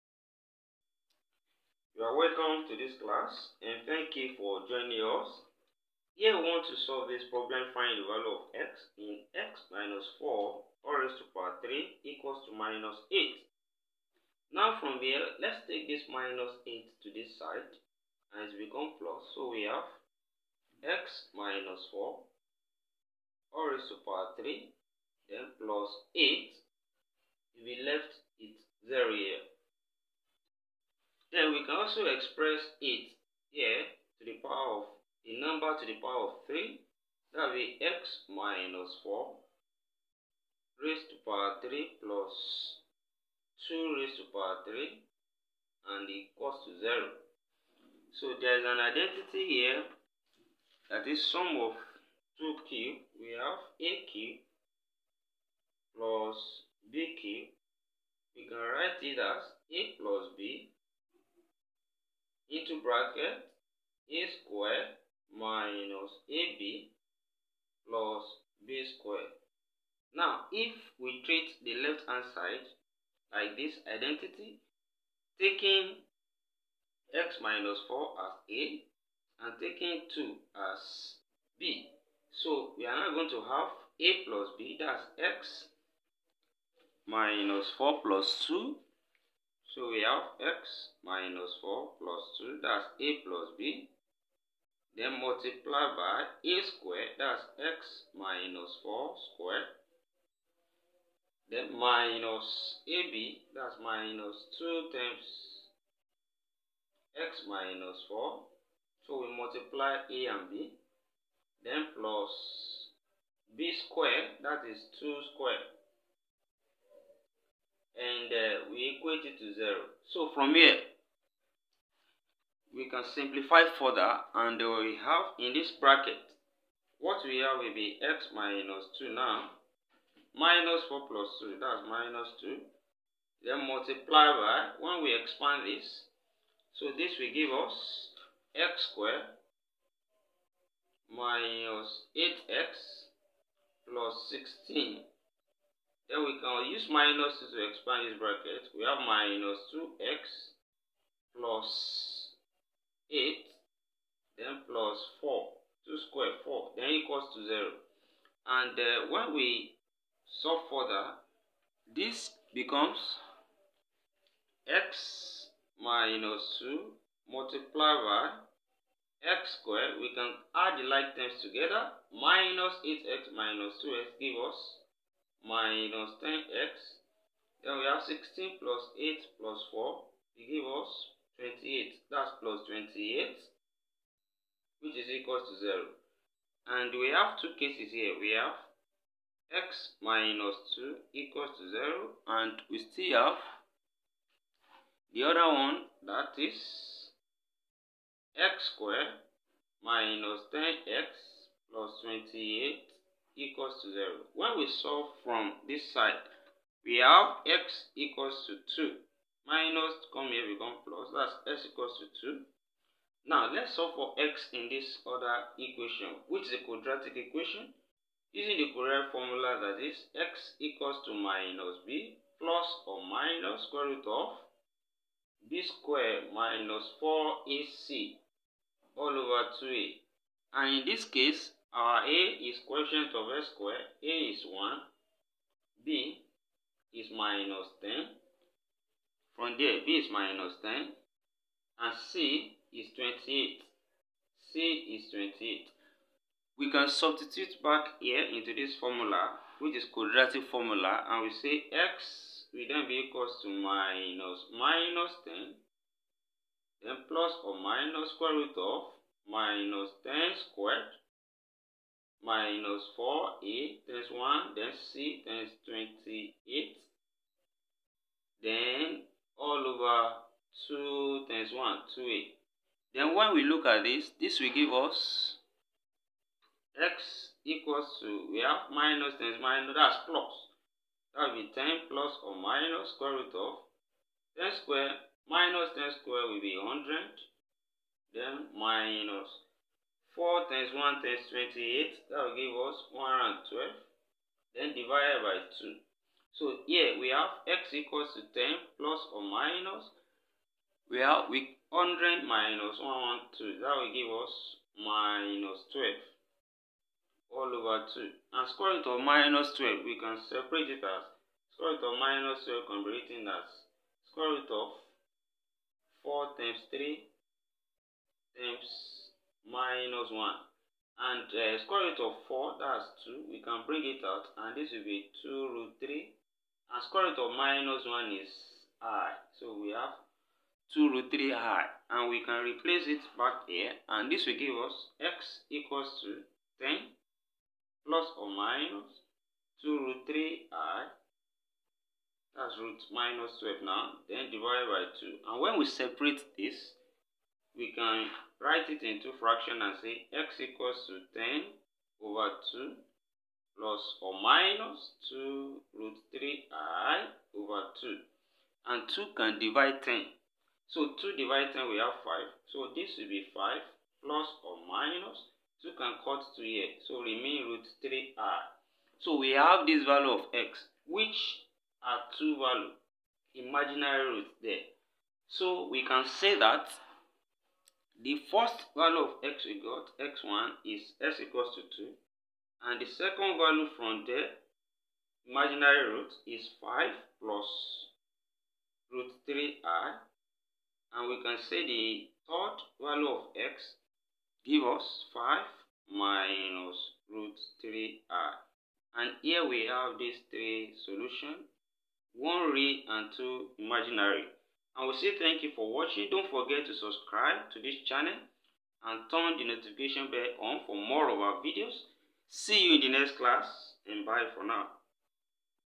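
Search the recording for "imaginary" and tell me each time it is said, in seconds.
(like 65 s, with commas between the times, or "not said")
373 s, 385 s, 403 s.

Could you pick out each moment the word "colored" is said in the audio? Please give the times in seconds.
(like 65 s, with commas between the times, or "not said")
not said.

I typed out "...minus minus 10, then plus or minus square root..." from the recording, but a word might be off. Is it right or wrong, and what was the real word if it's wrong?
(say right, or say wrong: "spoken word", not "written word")
right.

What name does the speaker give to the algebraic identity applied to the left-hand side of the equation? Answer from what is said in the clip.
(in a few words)
sum of 2 cubes.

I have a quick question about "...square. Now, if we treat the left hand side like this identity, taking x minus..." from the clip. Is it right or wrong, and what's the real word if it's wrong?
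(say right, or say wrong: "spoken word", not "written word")
right.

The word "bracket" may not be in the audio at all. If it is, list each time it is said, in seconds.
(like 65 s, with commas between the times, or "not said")
62 s, 125 s, 148 s.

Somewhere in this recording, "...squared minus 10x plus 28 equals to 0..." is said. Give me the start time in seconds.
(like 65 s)
198 s.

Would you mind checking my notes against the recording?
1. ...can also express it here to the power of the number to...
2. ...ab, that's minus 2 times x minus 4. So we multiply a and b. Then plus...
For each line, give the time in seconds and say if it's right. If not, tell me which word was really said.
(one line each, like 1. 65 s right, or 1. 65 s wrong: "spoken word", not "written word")
1. 31 s right
2. 102 s right.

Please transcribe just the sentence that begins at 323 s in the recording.
We can bring it out and this will be 2 root 3 and square root of minus 1 is i.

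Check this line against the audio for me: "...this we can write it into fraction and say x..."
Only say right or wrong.
right.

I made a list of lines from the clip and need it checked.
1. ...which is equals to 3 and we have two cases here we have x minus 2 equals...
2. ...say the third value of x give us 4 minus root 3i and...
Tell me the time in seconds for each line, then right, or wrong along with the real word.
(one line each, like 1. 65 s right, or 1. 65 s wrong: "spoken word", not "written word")
1. 184 s wrong: "0", not "3"
2. 391 s wrong: "5", not "4".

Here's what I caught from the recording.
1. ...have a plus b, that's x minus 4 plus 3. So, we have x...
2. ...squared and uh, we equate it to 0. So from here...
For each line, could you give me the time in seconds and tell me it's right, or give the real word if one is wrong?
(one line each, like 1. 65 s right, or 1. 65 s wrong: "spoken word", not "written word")
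1. 83 s wrong: "2", not "3"
2. 115 s right.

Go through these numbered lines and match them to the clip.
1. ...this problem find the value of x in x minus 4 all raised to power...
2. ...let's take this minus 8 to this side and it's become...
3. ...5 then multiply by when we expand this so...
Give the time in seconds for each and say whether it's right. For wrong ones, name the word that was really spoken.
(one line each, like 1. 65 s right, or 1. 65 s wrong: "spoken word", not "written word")
1. 7 s right
2. 15 s right
3. 132 s wrong: "2", not "5".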